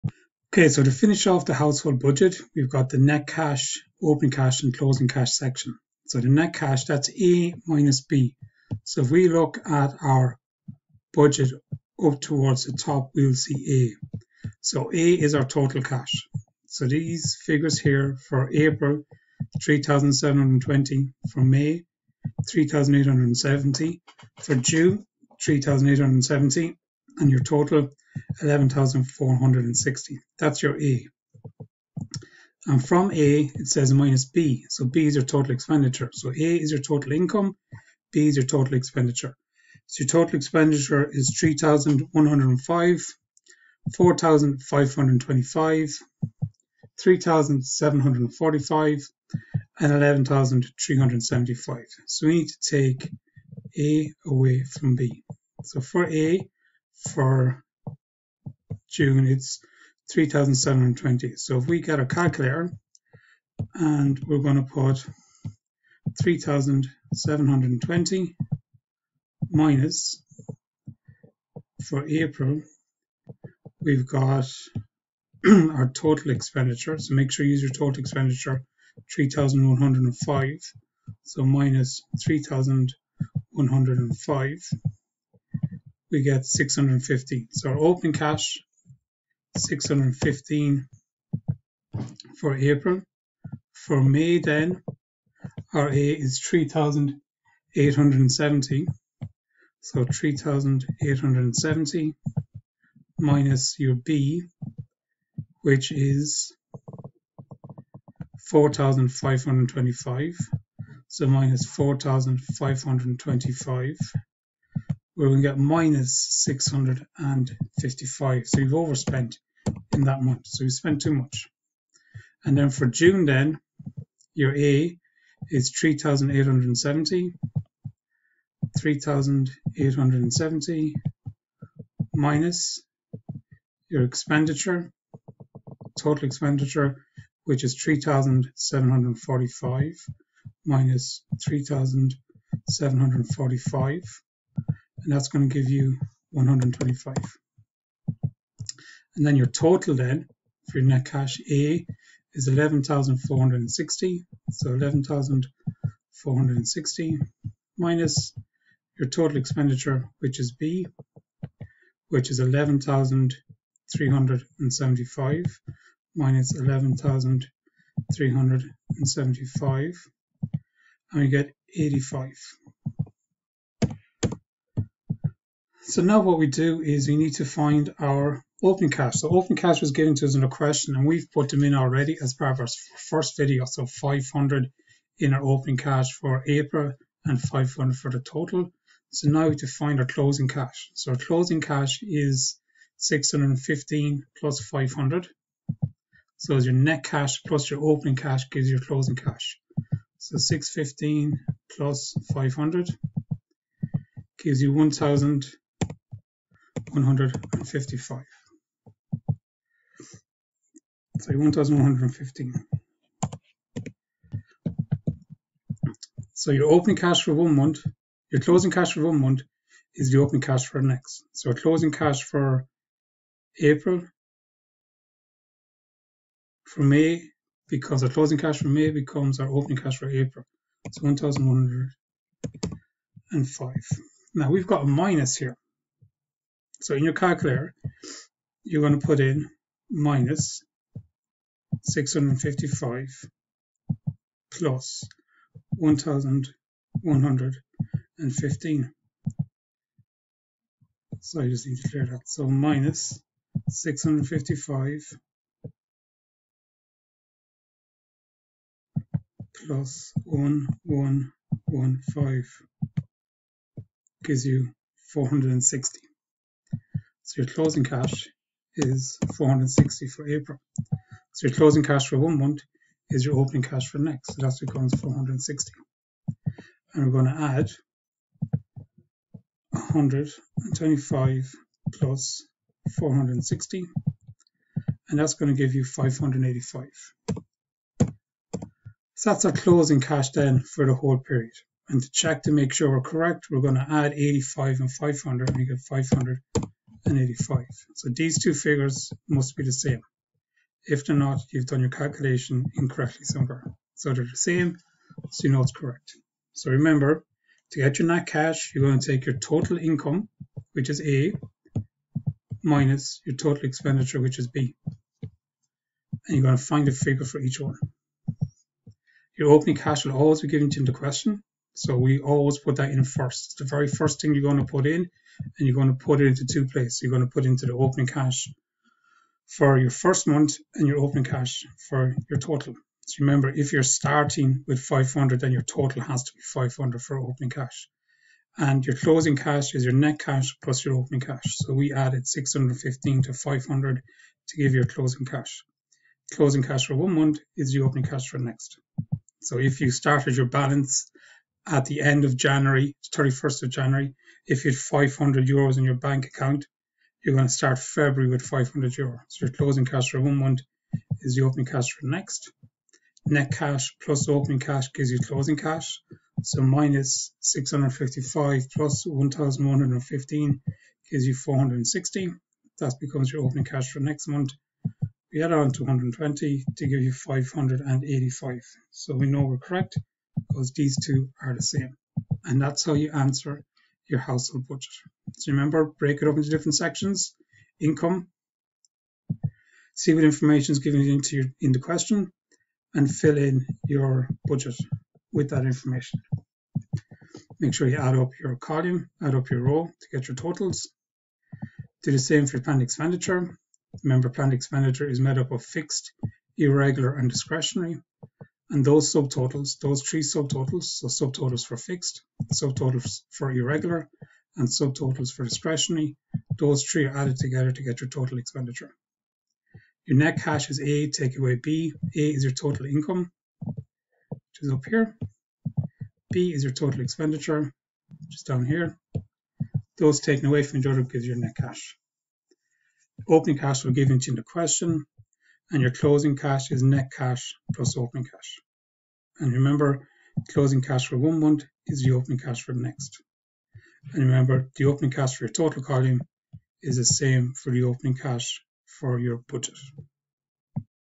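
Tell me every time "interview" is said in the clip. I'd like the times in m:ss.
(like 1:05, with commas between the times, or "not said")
not said.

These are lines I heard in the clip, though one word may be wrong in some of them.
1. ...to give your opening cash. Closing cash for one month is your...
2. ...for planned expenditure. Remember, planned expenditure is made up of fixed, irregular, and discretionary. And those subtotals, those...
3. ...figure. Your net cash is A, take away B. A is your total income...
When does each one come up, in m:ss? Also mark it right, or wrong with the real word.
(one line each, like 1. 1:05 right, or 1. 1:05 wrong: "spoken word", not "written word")
1. 5:44 wrong: "closing", not "opening"
2. 6:42 right
3. 6:58 wrong: "expenditure", not "figure".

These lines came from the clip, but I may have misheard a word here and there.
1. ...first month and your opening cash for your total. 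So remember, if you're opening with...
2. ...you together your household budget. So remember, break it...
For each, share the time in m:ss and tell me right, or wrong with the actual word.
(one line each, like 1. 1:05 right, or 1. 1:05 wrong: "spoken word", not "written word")
1. 5:29 wrong: "starting", not "opening"
2. 6:22 wrong: "answer", not "together".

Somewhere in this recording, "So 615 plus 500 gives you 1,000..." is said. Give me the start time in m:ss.
3:20.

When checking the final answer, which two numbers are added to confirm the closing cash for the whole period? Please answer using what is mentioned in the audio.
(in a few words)
85 and 500.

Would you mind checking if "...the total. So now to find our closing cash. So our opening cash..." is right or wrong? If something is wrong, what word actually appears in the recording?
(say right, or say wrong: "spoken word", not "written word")
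wrong: "closing", not "opening".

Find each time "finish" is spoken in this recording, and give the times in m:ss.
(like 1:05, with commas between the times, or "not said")
0:00.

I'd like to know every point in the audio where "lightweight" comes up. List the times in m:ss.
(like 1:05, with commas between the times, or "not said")
not said.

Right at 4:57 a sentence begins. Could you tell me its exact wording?
So these two figures must be the same.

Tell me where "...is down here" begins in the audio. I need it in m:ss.
7:08.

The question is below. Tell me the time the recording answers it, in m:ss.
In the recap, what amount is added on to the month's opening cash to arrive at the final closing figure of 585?
6:15.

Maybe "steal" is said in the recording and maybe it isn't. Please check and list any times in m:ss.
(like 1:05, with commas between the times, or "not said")
not said.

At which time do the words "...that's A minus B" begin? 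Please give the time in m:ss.
0:06.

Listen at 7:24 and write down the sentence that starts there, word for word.
And remember, the opening cash for your total column is the same for the opening cash for your budget.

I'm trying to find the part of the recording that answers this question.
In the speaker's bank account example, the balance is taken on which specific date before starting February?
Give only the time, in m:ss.
5:53.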